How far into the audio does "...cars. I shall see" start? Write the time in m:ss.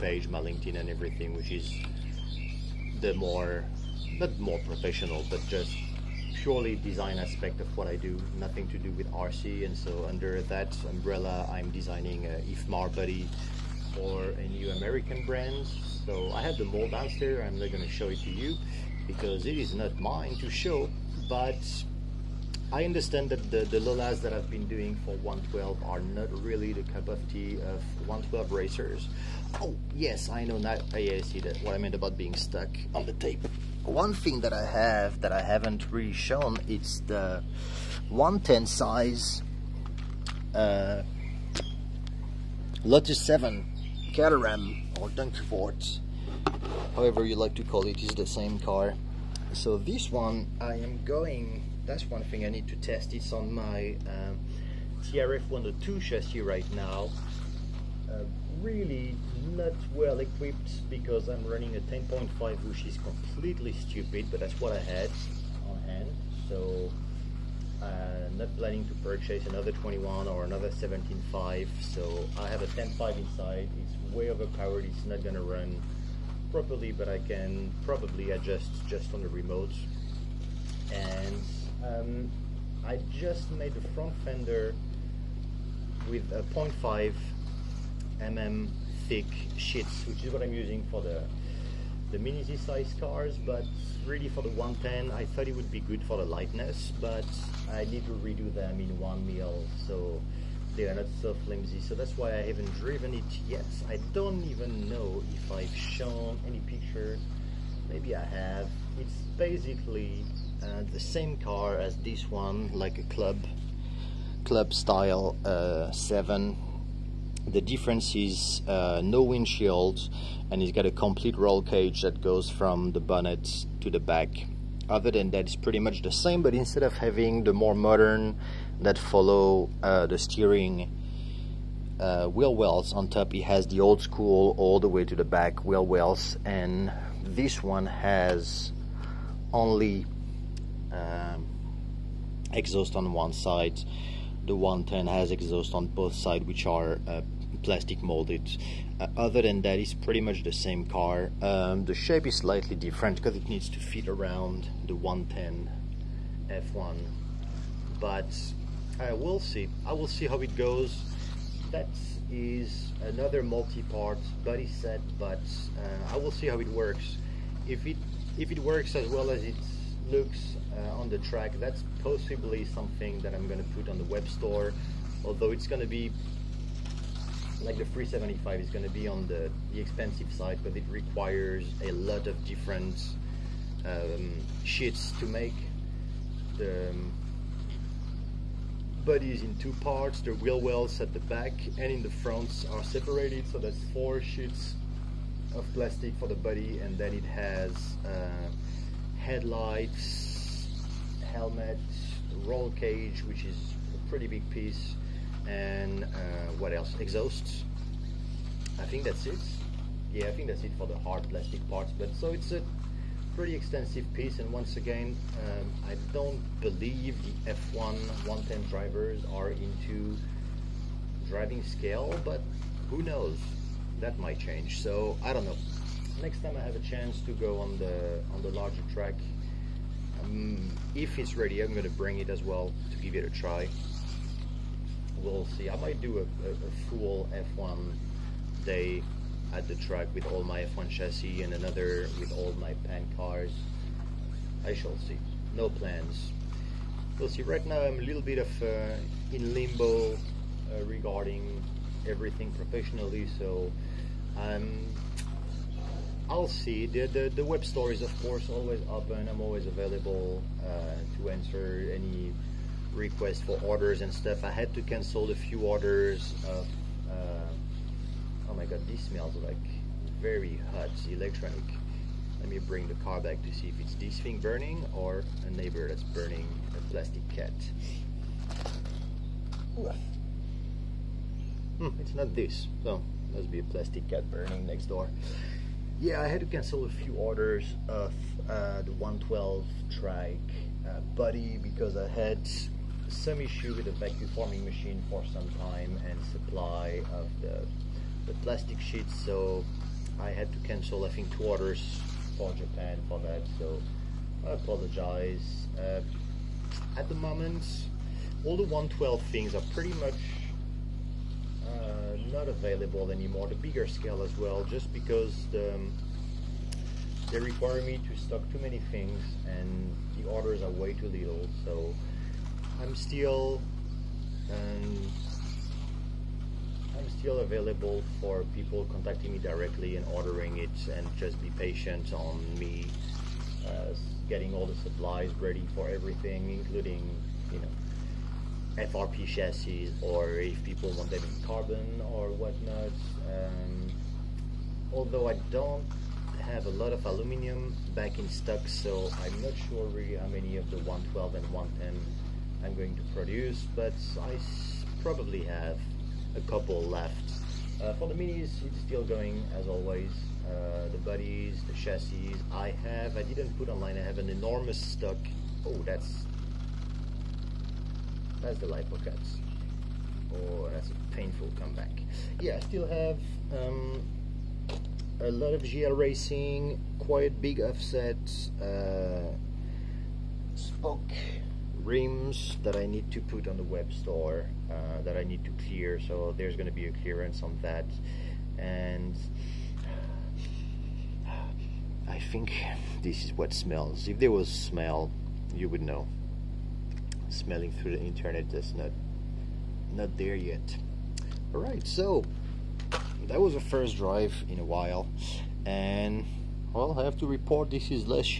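4:03.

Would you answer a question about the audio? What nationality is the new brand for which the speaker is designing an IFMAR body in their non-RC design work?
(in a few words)
American.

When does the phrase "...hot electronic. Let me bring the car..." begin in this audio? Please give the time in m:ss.
4:30.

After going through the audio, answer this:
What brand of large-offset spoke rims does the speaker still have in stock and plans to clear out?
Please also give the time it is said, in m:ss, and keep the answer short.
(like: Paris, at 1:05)
GL Racing, at 6:15.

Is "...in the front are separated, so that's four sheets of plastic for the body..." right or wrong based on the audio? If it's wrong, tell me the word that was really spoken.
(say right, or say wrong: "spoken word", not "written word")
right.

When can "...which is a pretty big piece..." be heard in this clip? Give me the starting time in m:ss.
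3:23.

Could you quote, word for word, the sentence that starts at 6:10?
Or oh, that's a painful comeback.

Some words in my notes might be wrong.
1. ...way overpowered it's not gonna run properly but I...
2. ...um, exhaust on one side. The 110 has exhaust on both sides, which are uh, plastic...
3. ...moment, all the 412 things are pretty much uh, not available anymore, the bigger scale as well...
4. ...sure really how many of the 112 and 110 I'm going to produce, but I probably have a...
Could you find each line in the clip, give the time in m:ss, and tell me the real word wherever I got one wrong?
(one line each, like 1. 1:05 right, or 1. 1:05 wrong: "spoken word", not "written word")
1. 1:14 right
2. 2:20 right
3. 5:07 wrong: "112", not "412"
4. 5:49 right.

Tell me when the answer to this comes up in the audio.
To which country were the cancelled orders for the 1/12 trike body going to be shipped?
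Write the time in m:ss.
5:02.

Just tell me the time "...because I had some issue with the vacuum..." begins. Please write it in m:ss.
4:51.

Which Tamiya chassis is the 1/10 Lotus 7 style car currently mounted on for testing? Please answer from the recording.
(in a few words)
TRF 102.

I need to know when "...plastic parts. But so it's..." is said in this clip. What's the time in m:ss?
3:31.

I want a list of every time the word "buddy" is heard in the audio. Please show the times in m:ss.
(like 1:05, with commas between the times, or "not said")
0:12, 4:51.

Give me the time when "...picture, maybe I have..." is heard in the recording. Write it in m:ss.
1:46.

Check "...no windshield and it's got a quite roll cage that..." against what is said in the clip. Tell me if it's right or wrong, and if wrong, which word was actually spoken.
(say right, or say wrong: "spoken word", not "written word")
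wrong: "complete", not "quite".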